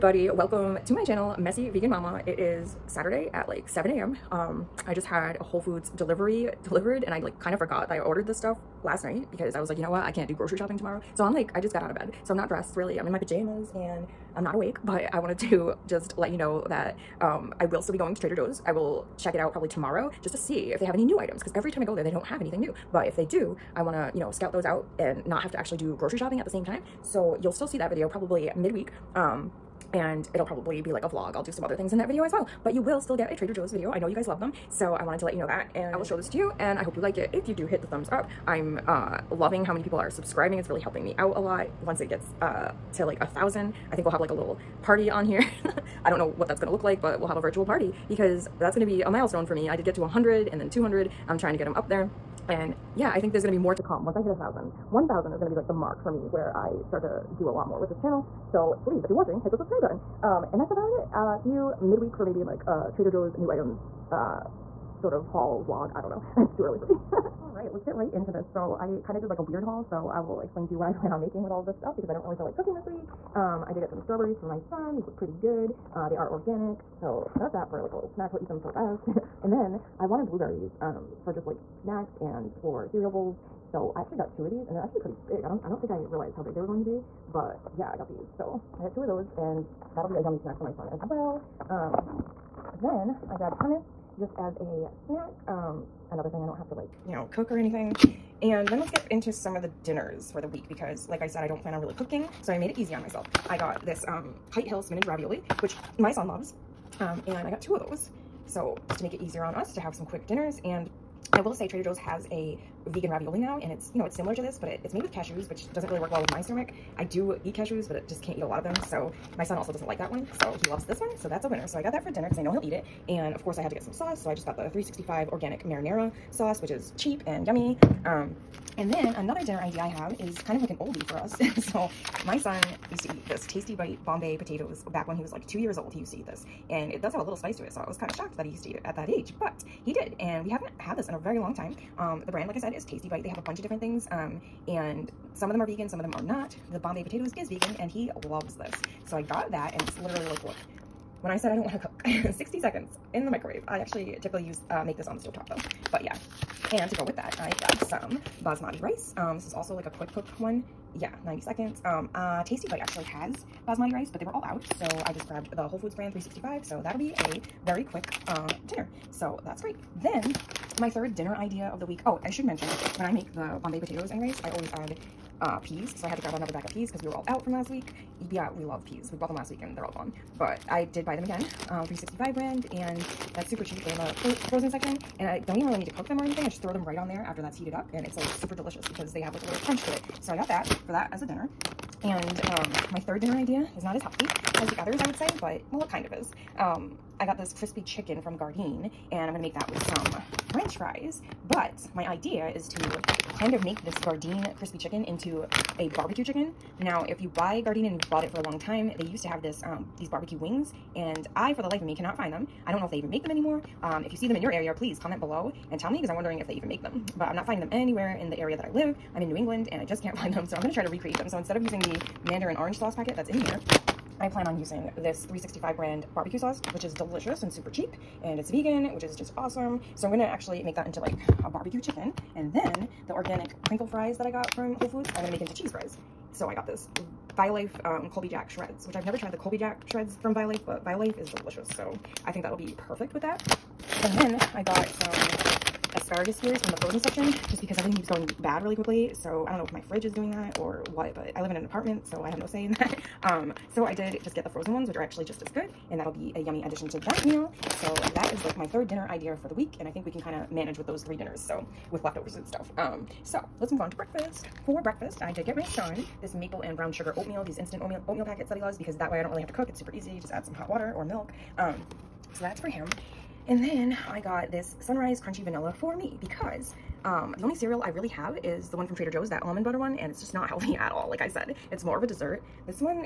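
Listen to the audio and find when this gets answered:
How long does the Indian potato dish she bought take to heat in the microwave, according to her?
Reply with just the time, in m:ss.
2:32.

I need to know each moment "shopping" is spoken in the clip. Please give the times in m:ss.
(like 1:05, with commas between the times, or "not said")
0:10, 0:26.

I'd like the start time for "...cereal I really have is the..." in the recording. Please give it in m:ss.
4:37.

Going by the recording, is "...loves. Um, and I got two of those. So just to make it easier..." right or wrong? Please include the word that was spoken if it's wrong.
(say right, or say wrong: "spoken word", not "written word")
right.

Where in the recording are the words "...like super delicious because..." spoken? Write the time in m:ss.
3:08.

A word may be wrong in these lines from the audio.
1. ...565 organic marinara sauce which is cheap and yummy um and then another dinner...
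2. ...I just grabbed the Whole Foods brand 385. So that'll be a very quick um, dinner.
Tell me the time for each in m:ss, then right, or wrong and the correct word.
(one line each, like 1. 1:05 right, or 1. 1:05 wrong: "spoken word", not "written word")
1. 2:04 wrong: "365", not "565"
2. 2:45 wrong: "365", not "385".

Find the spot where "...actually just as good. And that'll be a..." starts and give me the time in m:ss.
4:15.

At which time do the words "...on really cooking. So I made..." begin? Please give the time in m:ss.
1:41.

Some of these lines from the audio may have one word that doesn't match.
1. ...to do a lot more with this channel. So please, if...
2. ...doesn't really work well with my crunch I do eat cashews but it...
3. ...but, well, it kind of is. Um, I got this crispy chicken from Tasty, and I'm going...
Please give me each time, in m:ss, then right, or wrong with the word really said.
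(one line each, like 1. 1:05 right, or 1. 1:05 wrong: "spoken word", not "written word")
1. 0:57 right
2. 1:55 wrong: "stomach", not "crunch"
3. 3:15 wrong: "Gardein", not "Tasty".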